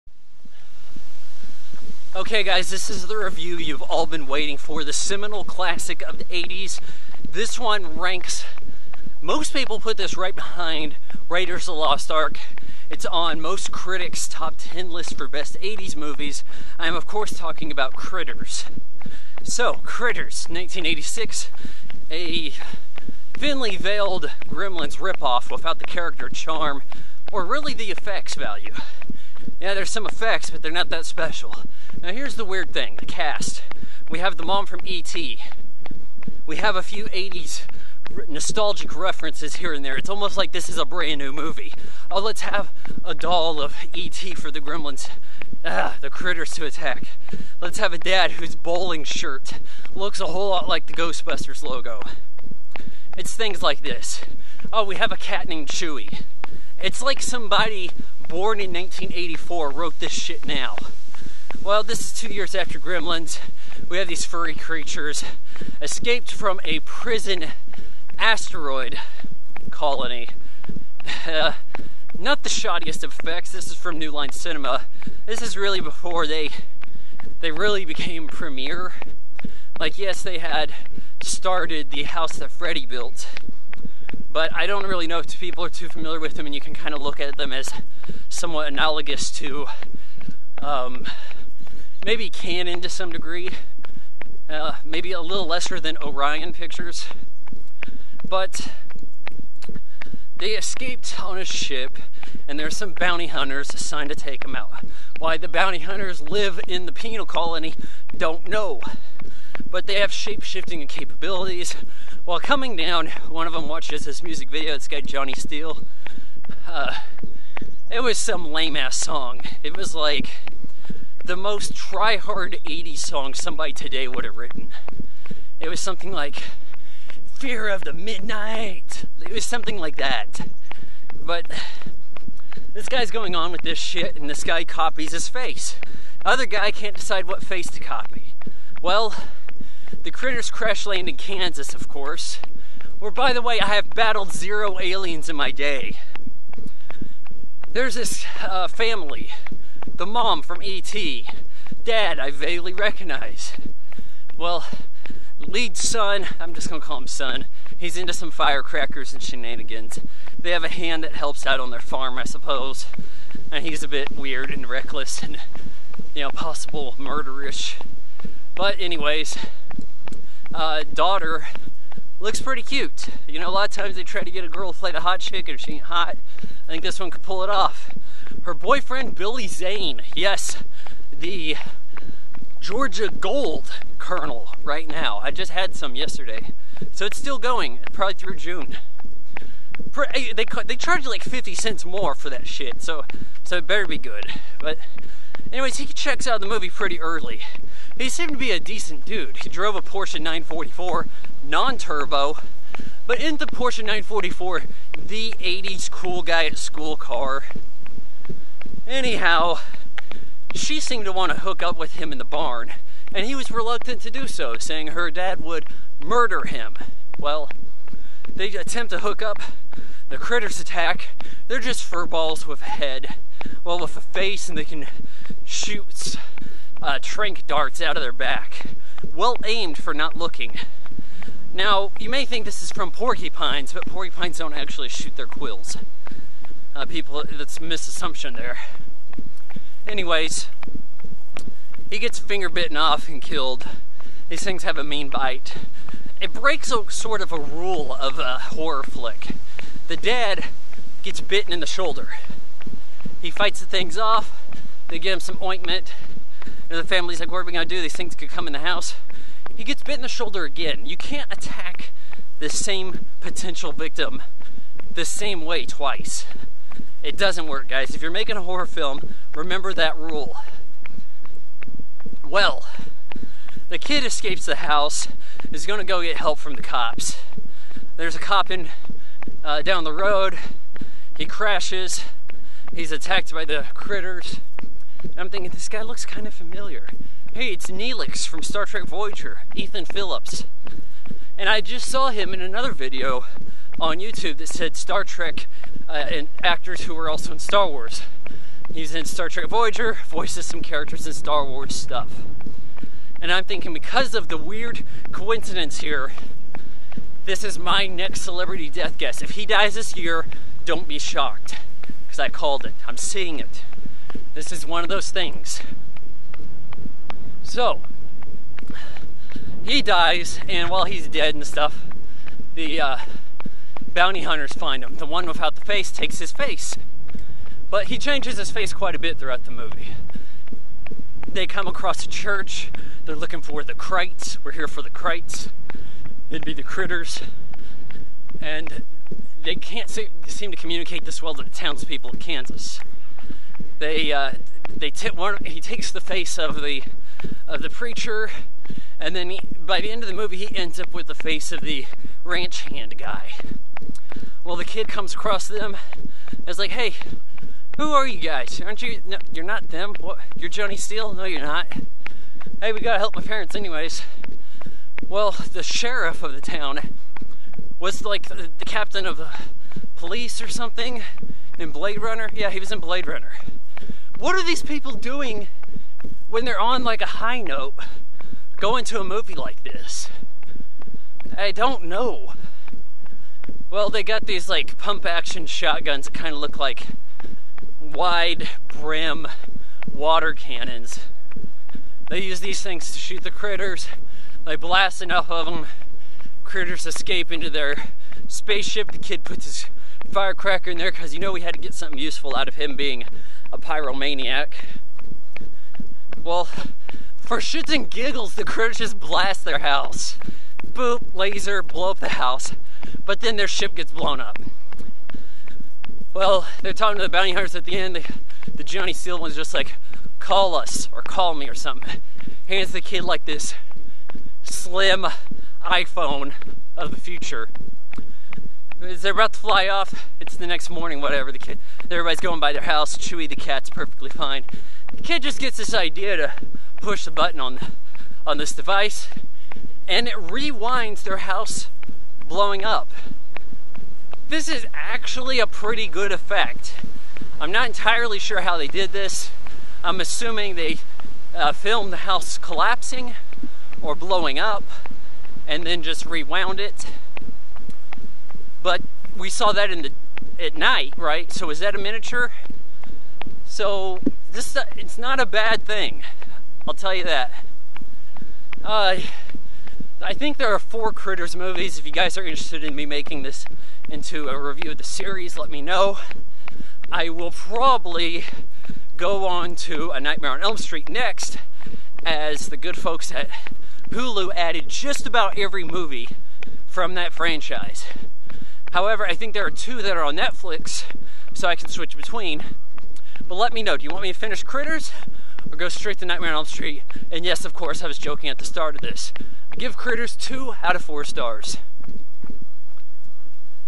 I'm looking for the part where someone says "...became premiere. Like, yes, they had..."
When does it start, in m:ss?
1:17.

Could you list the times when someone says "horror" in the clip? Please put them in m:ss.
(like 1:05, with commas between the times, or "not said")
4:08, 4:28.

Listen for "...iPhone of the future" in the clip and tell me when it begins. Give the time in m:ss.
7:05.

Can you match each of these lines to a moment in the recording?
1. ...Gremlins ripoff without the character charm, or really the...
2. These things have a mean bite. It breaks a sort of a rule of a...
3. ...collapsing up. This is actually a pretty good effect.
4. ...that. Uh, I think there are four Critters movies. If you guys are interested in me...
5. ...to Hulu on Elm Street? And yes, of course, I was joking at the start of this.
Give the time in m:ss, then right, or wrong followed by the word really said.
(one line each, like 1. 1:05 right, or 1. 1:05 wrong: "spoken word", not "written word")
1. 0:24 right
2. 4:04 right
3. 7:22 wrong: "blowing", not "collapsing"
4. 7:47 right
5. 8:15 wrong: "Nightmare", not "Hulu".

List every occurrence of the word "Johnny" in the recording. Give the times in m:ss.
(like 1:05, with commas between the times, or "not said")
1:55, 6:00, 6:58.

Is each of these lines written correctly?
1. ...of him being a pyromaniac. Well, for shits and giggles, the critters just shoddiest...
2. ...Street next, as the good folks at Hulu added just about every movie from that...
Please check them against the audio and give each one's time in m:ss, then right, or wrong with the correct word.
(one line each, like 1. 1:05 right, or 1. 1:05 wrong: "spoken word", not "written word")
1. 6:42 wrong: "blast", not "shoddiest"
2. 8:00 right.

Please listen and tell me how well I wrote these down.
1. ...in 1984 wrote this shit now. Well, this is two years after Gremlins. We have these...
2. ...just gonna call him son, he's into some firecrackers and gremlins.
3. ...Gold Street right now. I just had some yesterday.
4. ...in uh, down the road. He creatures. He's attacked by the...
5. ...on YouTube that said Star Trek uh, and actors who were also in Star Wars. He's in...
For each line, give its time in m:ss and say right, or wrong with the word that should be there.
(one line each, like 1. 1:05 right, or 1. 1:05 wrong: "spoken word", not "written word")
1. 0:58 right
2. 2:36 wrong: "shenanigans", not "gremlins"
3. 3:03 wrong: "Colonel", not "Street"
4. 4:38 wrong: "crashes", not "creatures"
5. 4:53 right.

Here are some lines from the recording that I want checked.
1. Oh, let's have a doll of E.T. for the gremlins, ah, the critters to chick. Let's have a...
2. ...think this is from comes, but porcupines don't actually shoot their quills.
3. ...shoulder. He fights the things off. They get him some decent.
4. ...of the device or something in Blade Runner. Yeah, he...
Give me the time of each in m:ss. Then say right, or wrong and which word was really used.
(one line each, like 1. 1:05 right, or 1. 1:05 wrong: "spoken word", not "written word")
1. 0:42 wrong: "attack", not "chick"
2. 3:52 wrong: "porcupines", not "comes"
3. 4:11 wrong: "ointment", not "decent"
4. 6:09 wrong: "police", not "device".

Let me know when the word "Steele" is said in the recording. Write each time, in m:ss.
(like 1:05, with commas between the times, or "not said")
1:55, 6:00, 6:58.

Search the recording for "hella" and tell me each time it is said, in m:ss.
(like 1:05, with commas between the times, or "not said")
not said.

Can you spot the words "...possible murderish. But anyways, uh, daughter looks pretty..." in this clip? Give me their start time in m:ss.
2:46.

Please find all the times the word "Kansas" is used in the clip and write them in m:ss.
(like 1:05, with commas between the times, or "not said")
2:21, 5:42.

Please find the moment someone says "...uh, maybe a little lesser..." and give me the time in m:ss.
1:34.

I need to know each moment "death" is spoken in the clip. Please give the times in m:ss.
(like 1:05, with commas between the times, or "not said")
5:08.